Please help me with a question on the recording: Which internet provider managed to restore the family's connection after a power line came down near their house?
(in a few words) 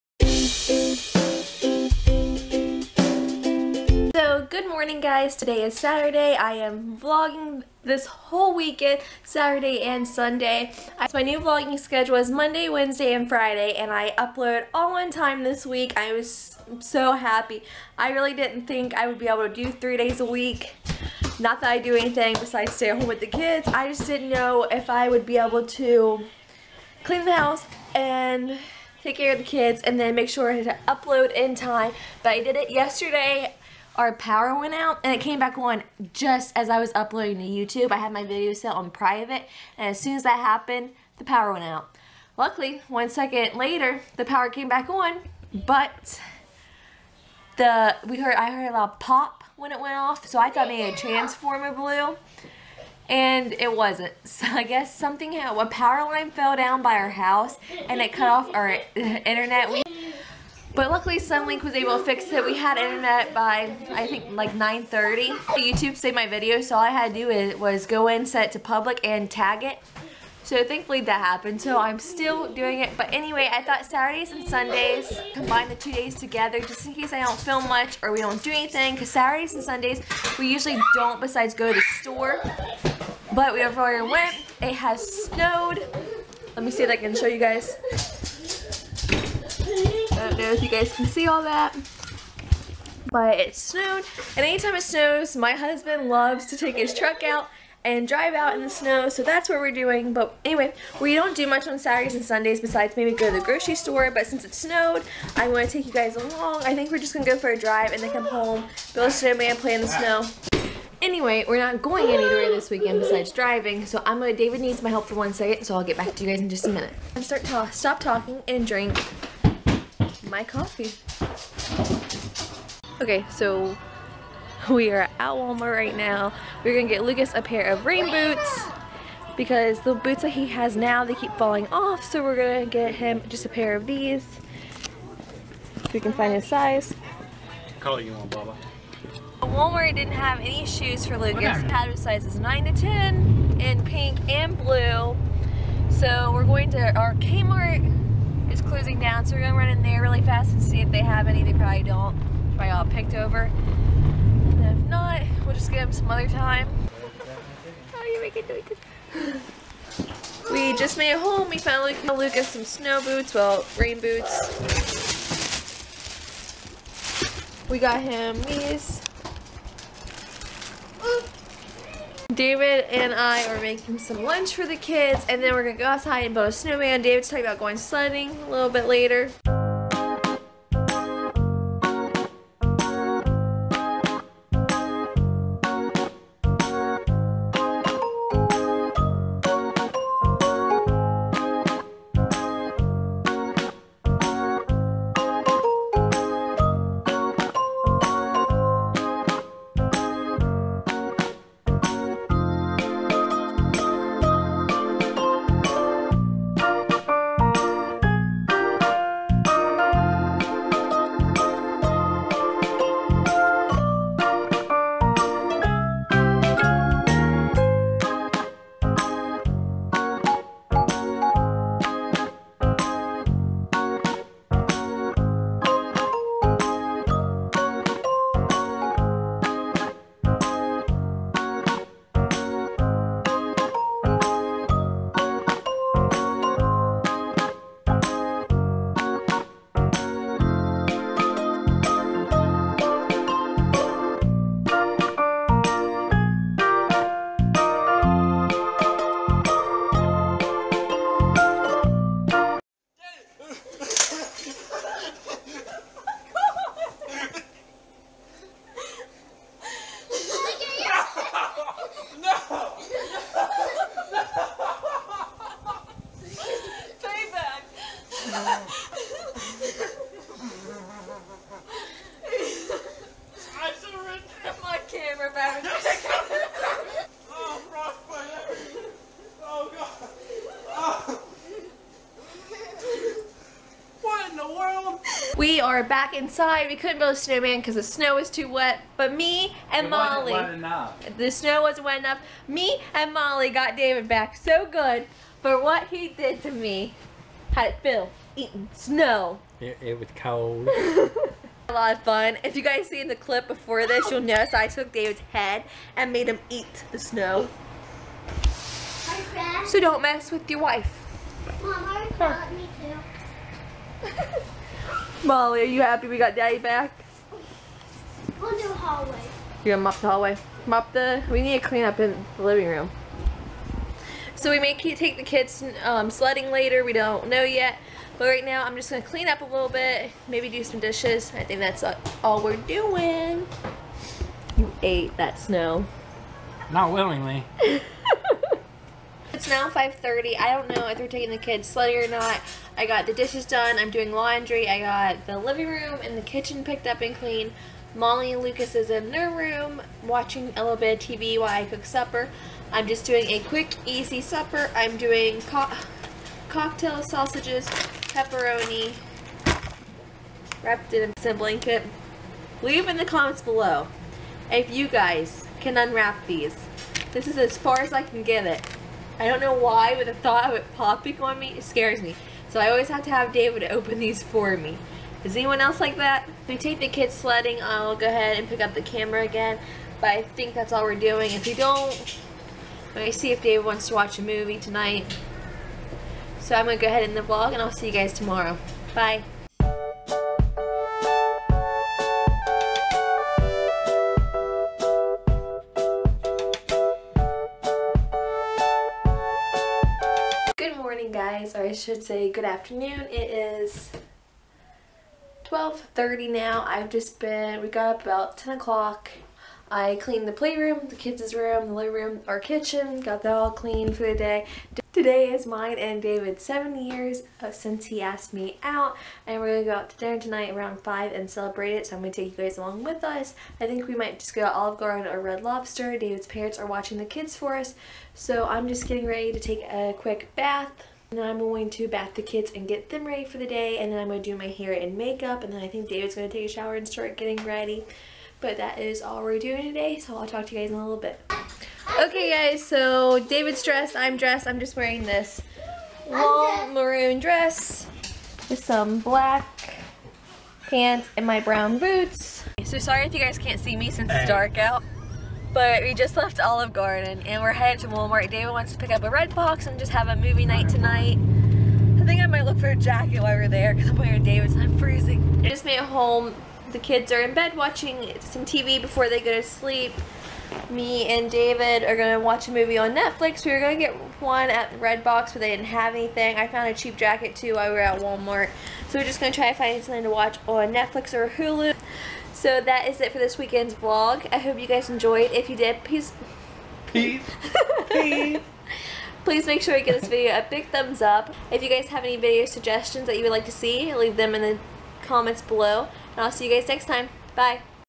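Suddenlink.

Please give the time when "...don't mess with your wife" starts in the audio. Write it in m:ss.
5:09.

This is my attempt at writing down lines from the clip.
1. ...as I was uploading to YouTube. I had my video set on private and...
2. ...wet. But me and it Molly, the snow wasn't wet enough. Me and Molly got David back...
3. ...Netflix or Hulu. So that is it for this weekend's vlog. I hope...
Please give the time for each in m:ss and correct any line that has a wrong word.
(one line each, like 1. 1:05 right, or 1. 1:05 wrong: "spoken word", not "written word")
1. 0:36 right
2. 4:48 right
3. 8:00 right.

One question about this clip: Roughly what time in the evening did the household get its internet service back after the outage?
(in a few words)
9:30.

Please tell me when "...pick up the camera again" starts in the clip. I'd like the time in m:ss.
6:18.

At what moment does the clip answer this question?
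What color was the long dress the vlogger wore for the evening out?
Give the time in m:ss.
7:26.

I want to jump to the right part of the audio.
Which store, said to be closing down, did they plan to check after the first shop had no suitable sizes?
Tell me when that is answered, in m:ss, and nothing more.
2:27.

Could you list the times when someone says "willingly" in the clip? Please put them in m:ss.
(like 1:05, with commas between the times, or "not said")
5:36.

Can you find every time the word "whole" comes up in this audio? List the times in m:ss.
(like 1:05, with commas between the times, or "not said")
0:08.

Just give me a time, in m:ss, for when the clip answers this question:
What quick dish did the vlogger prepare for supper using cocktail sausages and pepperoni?
6:00.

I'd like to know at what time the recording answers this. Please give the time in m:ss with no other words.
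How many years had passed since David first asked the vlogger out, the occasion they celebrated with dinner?
6:56.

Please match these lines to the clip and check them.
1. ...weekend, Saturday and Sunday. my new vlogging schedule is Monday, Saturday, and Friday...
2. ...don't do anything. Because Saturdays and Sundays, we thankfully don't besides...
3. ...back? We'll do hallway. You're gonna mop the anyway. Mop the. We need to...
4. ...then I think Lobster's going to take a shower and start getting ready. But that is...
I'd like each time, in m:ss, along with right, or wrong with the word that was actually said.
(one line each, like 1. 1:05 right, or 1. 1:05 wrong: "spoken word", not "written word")
1. 0:08 wrong: "Wednesday", not "Saturday"
2. 1:18 wrong: "usually", not "thankfully"
3. 5:16 wrong: "hallway", not "anyway"
4. 7:15 wrong: "David", not "Lobster".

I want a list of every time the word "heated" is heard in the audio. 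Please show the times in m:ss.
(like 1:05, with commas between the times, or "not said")
not said.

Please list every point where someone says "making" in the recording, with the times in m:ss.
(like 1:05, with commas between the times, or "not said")
2:38, 2:53.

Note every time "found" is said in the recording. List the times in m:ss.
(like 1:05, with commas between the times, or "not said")
2:41, 7:56.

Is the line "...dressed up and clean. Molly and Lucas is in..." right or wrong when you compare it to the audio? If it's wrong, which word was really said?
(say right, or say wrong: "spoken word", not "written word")
wrong: "picked", not "dressed".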